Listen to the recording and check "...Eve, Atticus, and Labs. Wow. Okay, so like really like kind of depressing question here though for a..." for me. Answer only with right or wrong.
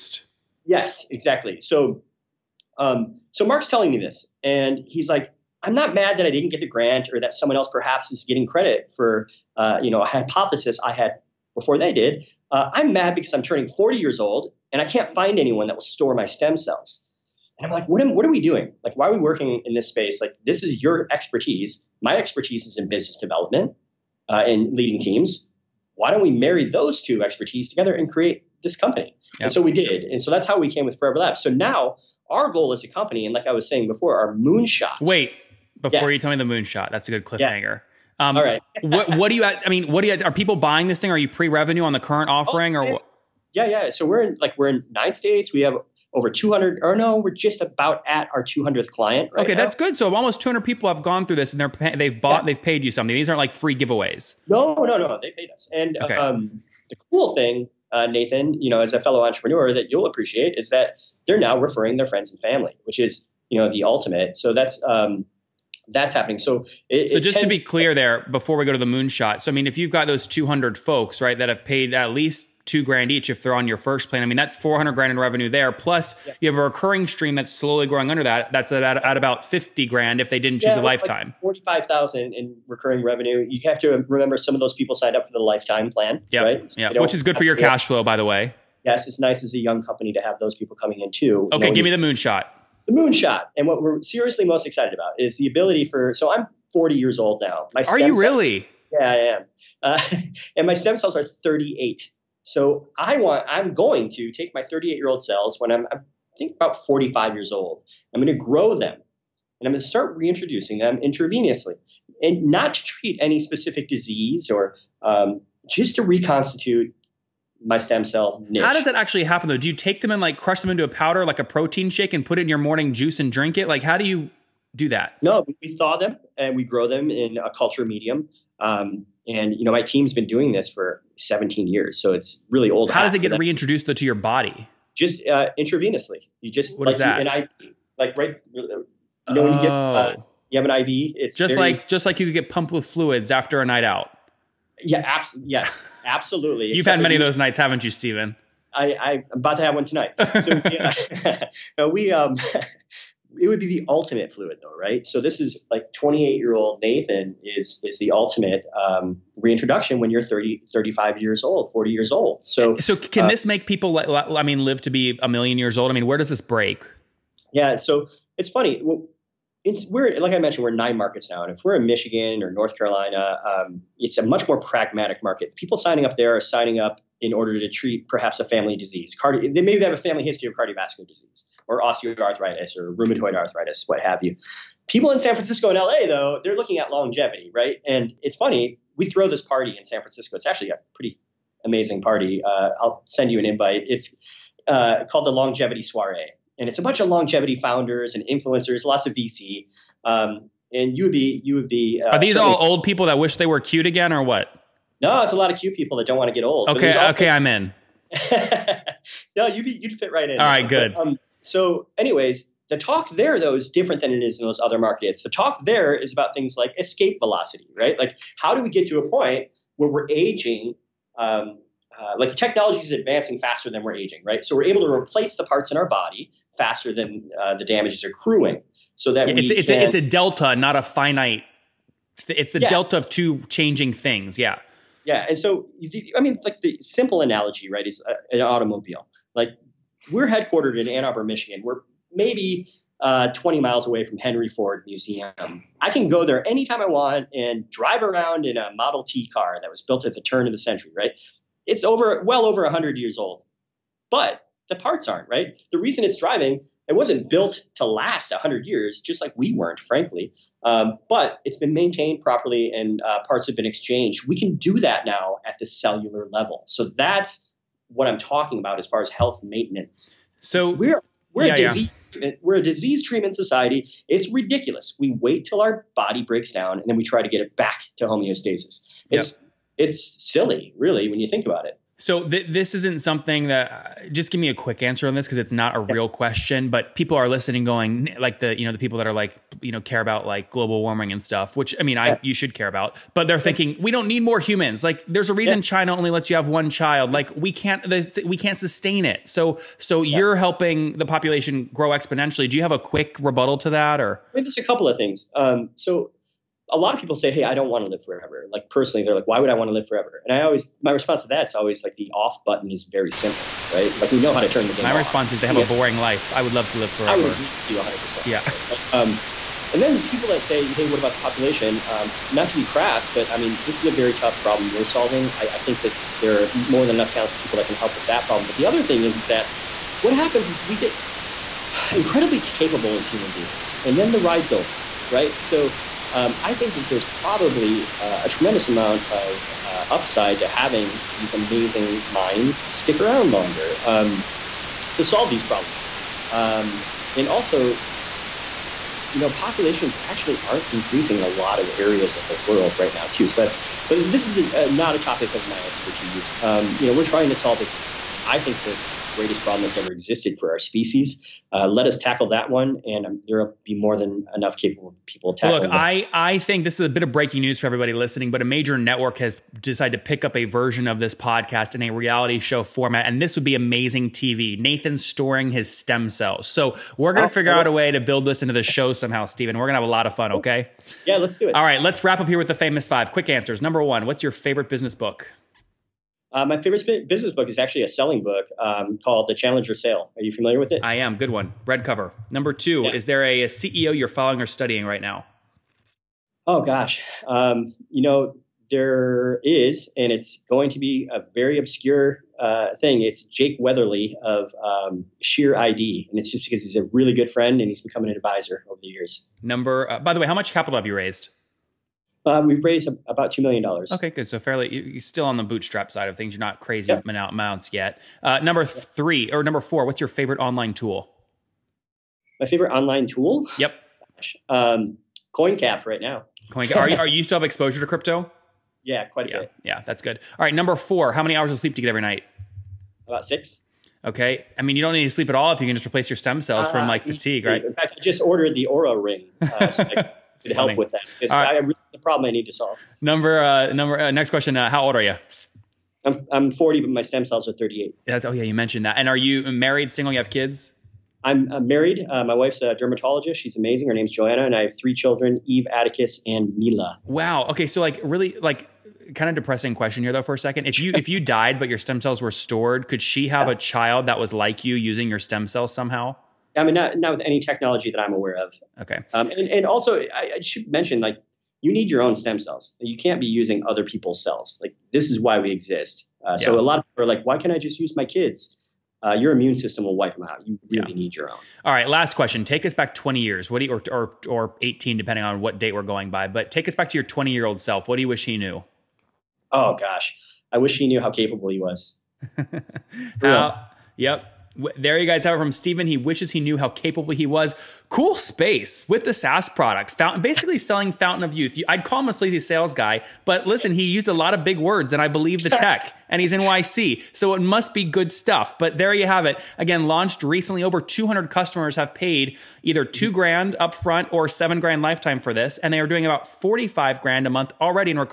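wrong.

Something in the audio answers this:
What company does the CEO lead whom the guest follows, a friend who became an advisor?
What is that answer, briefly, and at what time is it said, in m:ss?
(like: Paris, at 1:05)
SheerID, at 6:45.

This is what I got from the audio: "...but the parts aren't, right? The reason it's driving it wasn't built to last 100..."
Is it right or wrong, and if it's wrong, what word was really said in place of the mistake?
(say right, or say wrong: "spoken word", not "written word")
right.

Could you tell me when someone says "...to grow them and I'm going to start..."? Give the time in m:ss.
1:48.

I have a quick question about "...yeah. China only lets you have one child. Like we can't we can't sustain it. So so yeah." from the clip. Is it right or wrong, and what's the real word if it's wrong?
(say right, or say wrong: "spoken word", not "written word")
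right.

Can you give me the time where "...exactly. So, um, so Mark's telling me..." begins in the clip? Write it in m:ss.
0:01.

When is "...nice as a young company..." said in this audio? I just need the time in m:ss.
1:29.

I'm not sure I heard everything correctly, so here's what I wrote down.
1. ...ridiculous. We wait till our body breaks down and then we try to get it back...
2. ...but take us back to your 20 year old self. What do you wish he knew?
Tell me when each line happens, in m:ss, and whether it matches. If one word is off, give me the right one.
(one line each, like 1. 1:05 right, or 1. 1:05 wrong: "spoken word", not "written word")
1. 4:34 right
2. 8:06 right.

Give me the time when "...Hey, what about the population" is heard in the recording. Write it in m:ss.
5:20.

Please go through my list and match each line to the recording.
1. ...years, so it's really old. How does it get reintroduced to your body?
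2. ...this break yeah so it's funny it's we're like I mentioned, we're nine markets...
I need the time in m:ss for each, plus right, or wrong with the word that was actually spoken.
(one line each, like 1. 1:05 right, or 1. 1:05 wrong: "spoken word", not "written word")
1. 2:11 right
2. 2:46 right.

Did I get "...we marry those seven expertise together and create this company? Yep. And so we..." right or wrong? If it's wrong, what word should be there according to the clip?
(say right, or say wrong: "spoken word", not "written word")
wrong: "two", not "seven".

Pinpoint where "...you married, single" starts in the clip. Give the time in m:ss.
7:29.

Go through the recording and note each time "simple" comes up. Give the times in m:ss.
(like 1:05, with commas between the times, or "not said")
3:56, 5:13.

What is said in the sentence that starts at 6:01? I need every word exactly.
Uh, let us tackle that one, and um, Europe there will be more than enough capable people tackling.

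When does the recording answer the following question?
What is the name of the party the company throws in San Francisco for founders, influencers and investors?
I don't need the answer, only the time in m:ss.
3:15.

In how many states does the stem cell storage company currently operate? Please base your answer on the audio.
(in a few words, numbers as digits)
9.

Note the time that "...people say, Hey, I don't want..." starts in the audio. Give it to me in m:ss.
5:07.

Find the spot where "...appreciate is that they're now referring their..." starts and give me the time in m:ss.
1:00.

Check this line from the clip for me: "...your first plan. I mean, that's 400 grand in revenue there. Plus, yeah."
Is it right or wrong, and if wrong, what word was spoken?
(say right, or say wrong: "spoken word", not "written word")
right.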